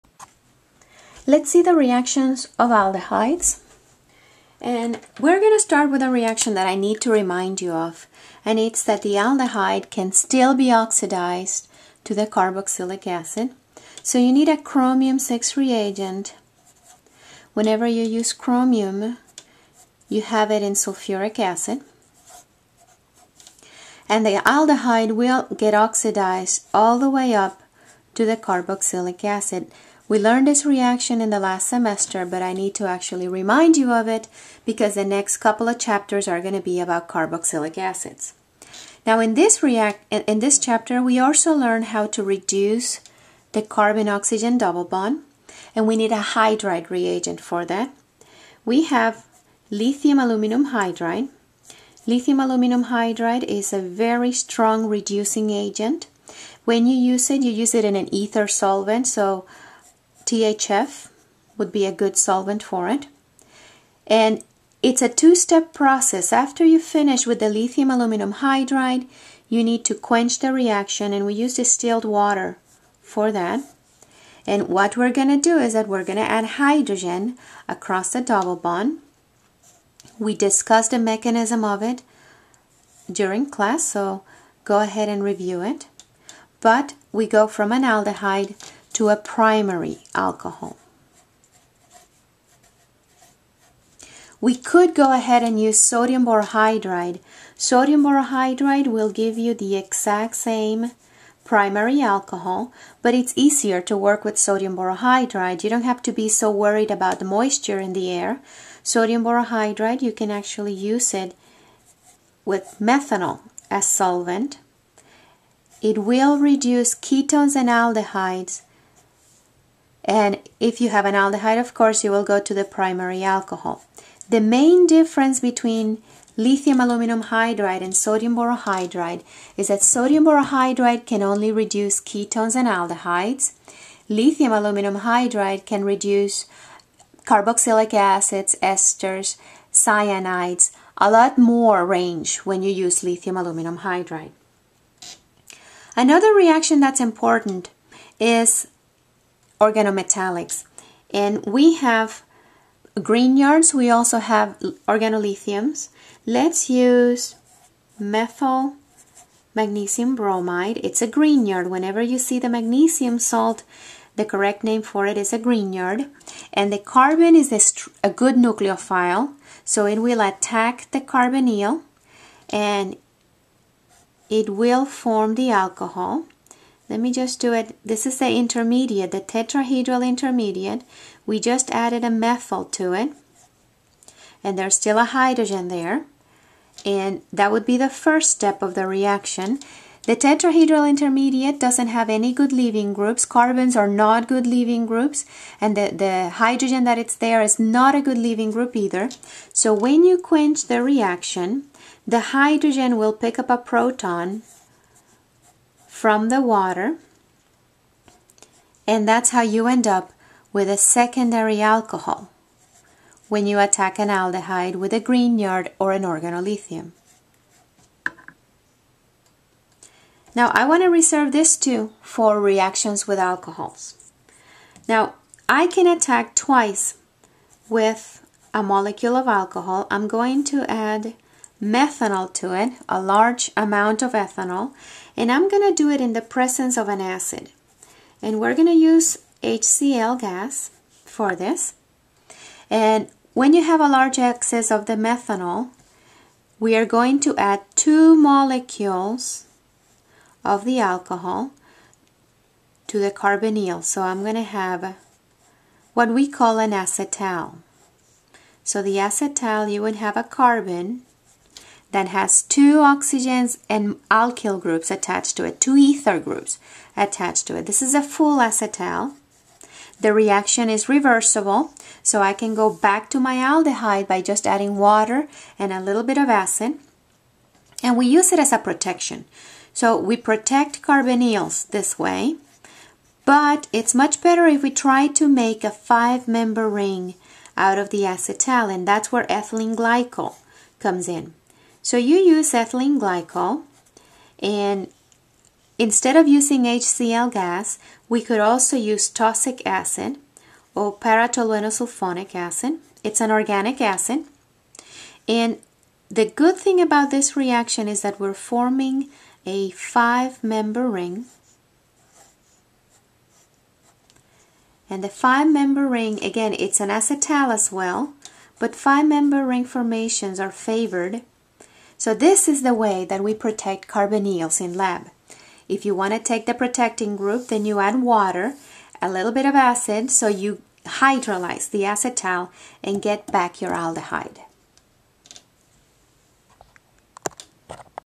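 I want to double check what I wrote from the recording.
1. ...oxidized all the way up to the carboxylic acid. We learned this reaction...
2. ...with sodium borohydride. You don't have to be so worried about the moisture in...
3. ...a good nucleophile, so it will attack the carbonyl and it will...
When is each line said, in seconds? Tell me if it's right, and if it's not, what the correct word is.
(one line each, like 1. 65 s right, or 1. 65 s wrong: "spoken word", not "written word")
1. 25 s right
2. 104 s right
3. 168 s right.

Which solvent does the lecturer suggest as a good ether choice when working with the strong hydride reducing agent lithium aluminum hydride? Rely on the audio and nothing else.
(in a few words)
THF.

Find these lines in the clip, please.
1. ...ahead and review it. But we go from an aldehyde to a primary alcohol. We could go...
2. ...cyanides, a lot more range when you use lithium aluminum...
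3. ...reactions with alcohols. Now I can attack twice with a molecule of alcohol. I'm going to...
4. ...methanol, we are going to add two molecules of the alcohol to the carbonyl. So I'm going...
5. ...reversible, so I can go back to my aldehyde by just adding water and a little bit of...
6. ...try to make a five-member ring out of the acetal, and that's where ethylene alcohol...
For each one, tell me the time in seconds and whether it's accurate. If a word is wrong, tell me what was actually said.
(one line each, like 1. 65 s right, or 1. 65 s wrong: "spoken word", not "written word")
1. 84 s right
2. 139 s right
3. 222 s right
4. 244 s right
5. 270 s right
6. 284 s wrong: "glycol", not "alcohol".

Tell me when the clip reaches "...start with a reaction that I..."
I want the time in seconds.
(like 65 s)
5 s.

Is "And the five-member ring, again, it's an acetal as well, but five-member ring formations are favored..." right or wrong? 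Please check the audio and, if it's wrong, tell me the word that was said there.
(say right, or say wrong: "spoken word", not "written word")
right.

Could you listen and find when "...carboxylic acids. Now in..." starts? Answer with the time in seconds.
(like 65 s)
37 s.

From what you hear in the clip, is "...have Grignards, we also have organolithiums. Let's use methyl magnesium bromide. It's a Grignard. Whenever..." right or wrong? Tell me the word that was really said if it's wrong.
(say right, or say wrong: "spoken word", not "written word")
right.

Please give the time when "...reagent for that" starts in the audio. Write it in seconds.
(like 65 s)
46 s.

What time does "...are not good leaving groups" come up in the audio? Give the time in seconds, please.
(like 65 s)
193 s.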